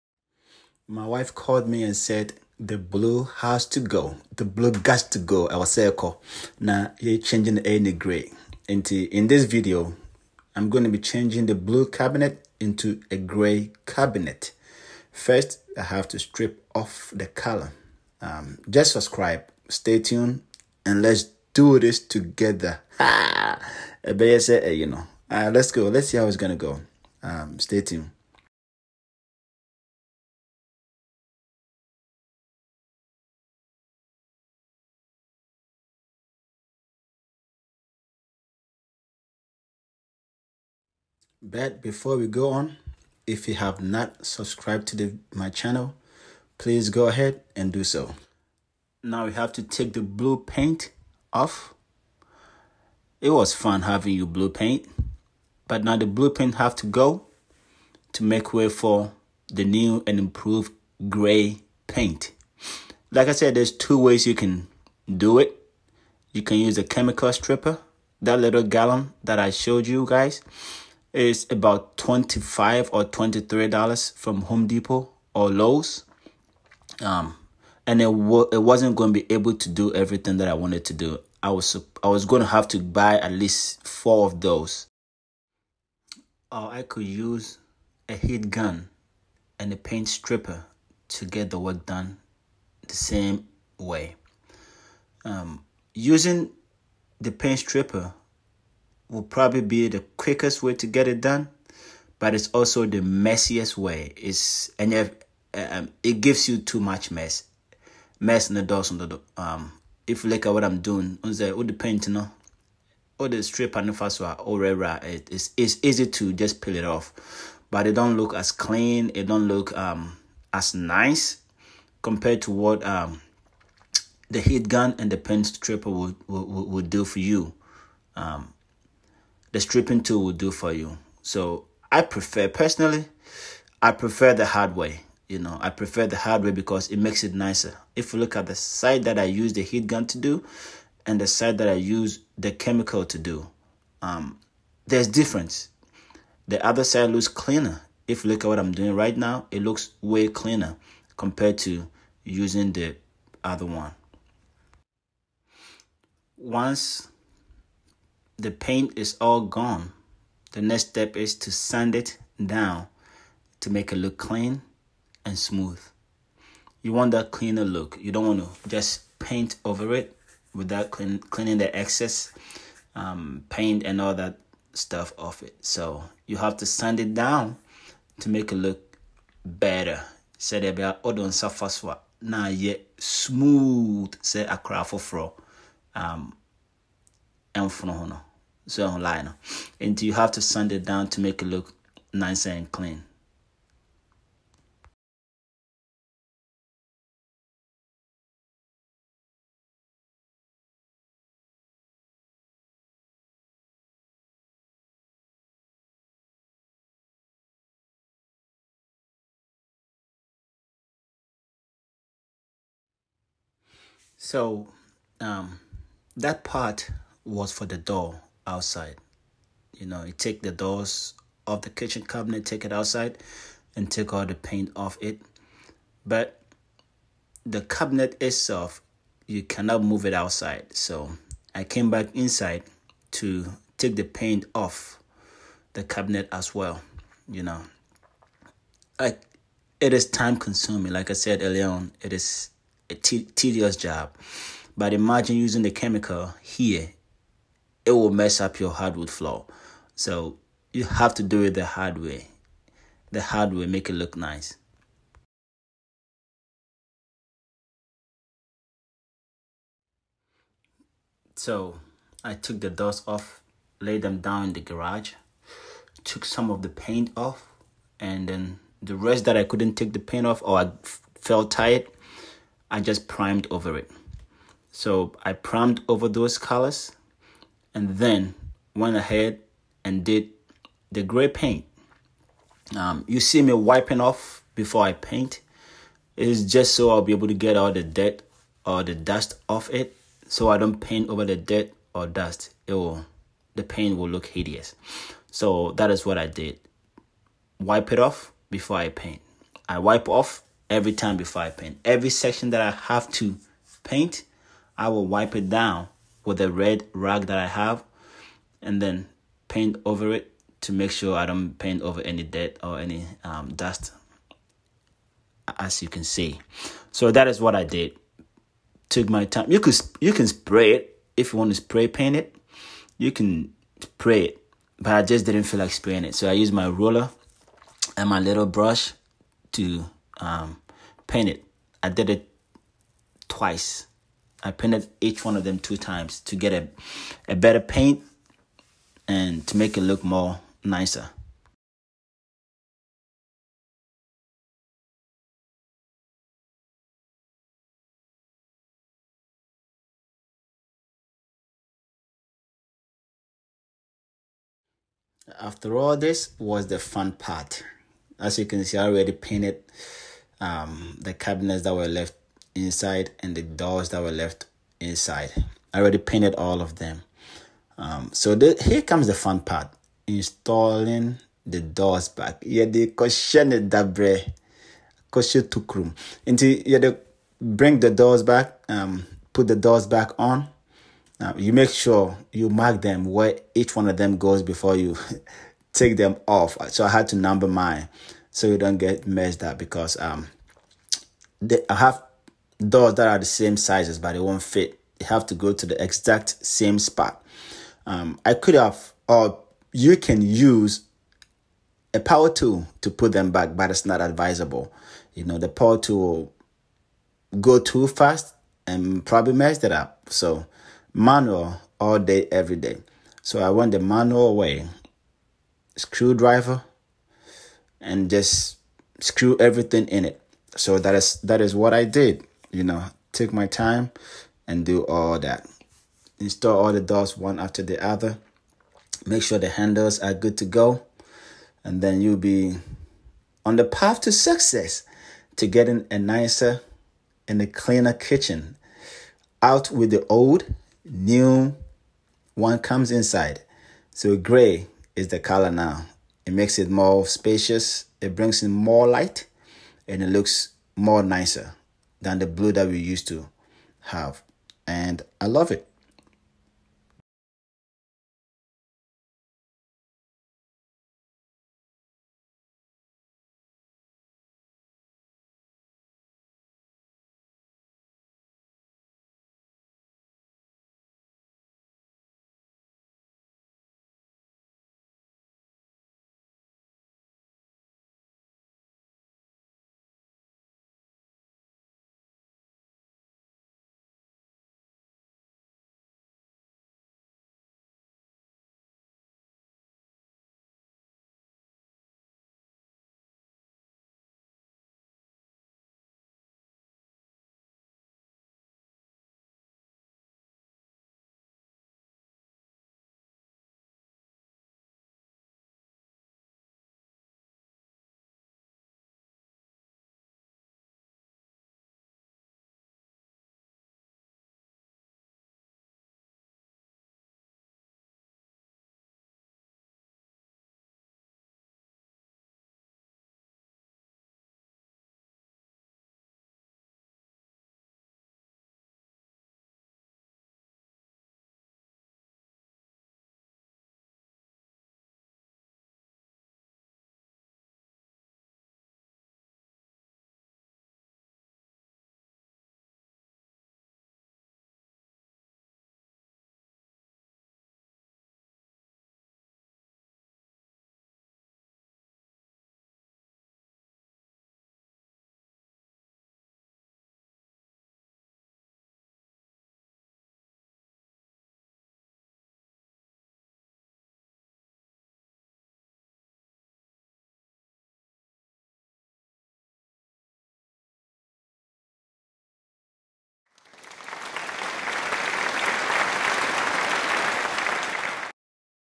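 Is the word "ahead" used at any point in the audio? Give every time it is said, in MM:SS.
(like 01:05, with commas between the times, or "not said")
00:47, 04:38.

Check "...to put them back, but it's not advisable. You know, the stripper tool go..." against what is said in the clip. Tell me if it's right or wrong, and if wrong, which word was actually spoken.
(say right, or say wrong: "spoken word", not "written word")
wrong: "power", not "stripper".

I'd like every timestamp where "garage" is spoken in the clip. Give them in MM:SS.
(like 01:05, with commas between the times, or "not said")
04:24.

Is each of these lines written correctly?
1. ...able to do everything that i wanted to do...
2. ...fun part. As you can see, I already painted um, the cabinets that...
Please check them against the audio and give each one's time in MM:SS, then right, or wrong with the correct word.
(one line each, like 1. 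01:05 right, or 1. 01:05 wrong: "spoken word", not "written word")
1. 01:19 right
2. 05:56 right.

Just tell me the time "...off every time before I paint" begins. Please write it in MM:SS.
05:00.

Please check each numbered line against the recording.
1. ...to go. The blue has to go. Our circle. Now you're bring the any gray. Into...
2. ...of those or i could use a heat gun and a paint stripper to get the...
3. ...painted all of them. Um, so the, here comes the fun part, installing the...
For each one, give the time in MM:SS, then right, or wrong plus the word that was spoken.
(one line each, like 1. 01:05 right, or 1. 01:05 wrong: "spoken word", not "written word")
1. 00:03 wrong: "changing", not "bring"
2. 01:24 right
3. 06:05 right.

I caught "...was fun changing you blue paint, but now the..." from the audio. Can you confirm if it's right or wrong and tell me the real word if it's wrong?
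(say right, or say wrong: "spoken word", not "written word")
wrong: "having", not "changing".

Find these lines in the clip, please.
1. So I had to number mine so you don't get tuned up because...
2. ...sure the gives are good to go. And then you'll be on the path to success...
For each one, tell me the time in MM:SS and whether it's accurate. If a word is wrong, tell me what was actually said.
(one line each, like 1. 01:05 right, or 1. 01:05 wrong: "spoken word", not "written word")
1. 06:26 wrong: "messed", not "tuned"
2. 07:09 wrong: "handles", not "gives".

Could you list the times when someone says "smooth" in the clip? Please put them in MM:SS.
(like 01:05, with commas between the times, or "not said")
02:45, 03:02.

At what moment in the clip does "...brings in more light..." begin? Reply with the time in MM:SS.
07:28.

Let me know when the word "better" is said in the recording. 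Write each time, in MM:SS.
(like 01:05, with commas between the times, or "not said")
02:59, 05:37.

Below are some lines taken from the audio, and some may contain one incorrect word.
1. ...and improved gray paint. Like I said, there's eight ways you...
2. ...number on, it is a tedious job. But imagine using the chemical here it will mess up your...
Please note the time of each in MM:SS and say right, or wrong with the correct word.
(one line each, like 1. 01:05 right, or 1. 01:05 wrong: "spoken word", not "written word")
1. 01:00 wrong: "two", not "eight"
2. 04:01 wrong: "earlier", not "number".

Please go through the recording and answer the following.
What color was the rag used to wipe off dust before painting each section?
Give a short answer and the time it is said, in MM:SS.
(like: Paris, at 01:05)
Red, at 05:06.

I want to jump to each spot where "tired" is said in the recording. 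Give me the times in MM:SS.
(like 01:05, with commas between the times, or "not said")
04:31.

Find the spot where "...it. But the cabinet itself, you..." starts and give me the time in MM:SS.
03:45.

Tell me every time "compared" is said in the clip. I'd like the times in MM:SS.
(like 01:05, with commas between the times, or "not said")
02:02, 02:31.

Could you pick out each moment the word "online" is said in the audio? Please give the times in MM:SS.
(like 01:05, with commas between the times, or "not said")
03:08.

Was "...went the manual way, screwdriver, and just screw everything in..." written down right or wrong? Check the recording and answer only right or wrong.
right.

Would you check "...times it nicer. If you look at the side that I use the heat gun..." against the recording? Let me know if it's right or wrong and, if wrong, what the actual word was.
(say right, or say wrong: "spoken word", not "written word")
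wrong: "makes", not "times".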